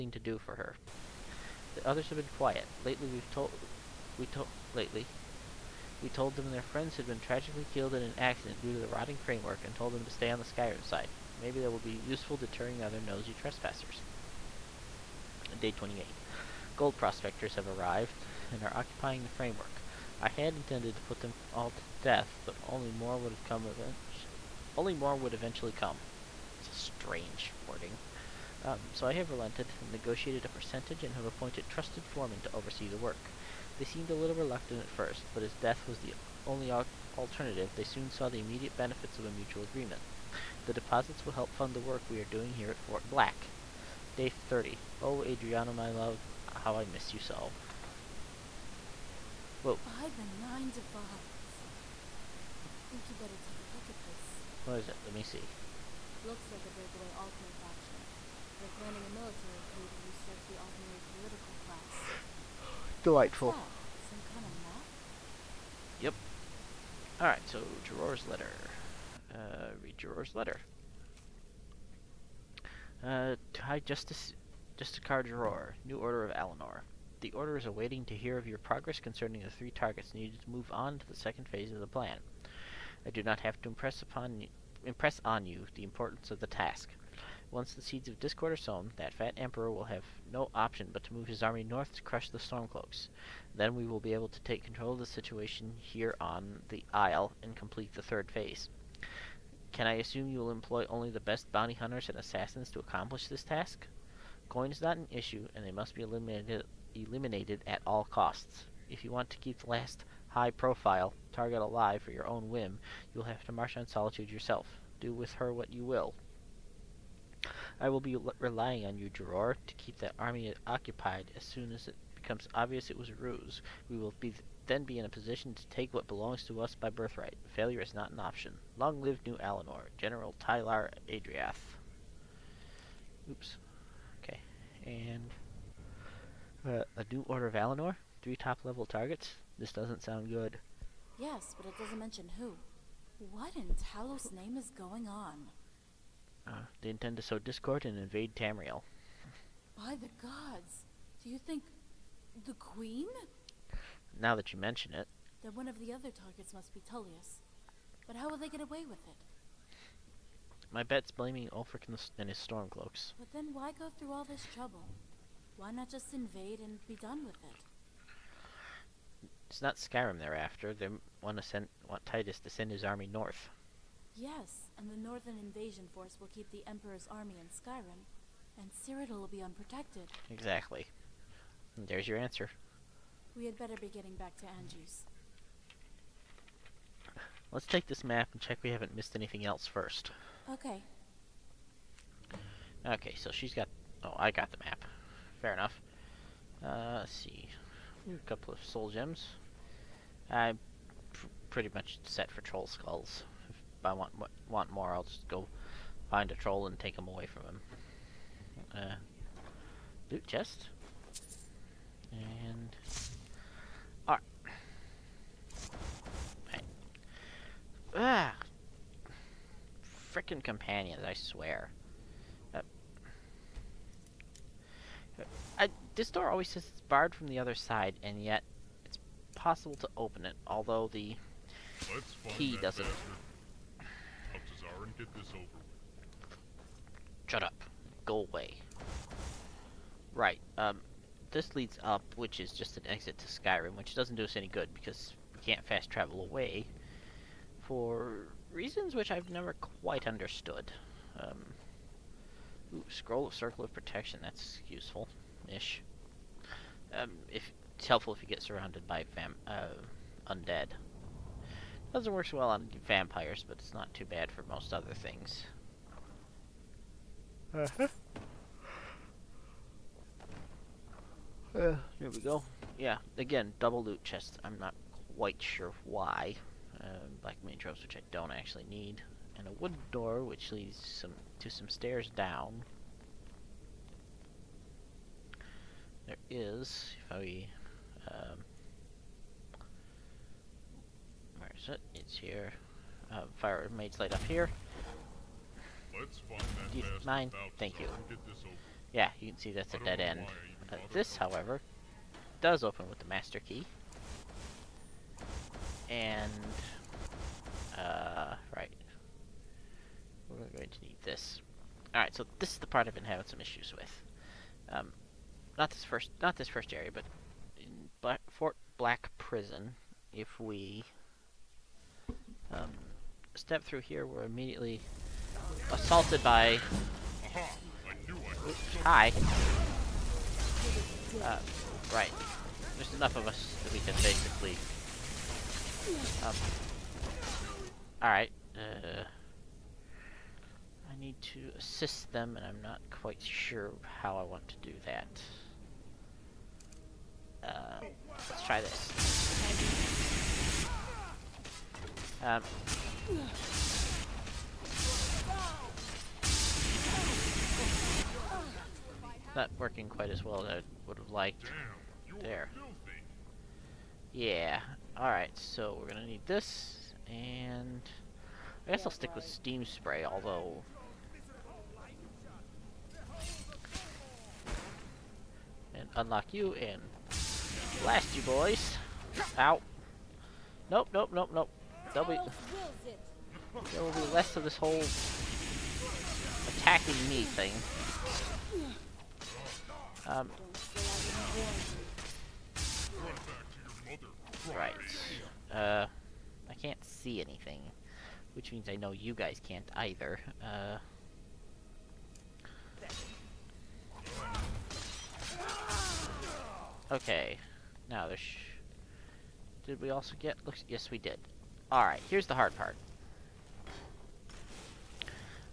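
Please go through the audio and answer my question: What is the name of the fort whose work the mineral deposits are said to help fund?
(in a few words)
Fort Black.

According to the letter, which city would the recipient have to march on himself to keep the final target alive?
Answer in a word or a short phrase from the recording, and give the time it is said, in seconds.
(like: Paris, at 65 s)
Solitude, at 113 s.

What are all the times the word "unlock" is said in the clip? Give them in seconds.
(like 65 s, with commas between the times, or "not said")
375 s.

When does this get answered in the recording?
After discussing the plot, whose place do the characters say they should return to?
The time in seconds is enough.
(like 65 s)
184 s.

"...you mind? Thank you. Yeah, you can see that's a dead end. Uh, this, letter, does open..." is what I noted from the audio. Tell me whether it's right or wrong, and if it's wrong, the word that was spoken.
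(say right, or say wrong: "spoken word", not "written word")
wrong: "however", not "letter".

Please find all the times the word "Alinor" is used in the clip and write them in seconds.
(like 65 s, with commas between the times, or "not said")
76 s, 129 s, 137 s.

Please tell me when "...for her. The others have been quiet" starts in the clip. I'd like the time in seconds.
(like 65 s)
0 s.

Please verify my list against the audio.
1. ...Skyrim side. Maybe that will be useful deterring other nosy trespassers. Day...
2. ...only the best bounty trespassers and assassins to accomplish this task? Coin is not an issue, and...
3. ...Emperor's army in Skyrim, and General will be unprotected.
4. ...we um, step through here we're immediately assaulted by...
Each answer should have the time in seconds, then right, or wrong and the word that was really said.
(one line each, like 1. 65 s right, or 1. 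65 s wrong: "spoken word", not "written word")
1. 10 s right
2. 100 s wrong: "hunters", not "trespassers"
3. 176 s wrong: "Cyrodiil", not "General"
4. 320 s right.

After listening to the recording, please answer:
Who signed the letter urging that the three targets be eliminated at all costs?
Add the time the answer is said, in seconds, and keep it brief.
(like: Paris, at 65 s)
General Tylar Adriath, at 129 s.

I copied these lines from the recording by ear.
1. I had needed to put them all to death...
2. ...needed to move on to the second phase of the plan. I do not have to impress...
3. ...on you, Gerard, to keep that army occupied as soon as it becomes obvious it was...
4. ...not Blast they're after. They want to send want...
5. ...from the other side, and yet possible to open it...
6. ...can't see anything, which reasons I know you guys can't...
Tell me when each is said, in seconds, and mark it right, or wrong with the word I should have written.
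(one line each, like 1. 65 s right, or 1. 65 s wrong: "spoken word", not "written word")
1. 20 s wrong: "intended", not "needed"
2. 80 s right
3. 118 s right
4. 169 s wrong: "Skyrim", not "Blast"
5. 227 s right
6. 396 s wrong: "means", not "reasons".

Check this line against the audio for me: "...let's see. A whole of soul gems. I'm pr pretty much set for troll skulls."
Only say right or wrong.
wrong.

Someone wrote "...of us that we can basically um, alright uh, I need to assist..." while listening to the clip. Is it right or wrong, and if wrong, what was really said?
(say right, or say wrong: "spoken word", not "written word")
right.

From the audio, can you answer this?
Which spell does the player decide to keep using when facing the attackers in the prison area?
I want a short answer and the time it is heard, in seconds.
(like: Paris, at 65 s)
Steam Spray, at 369 s.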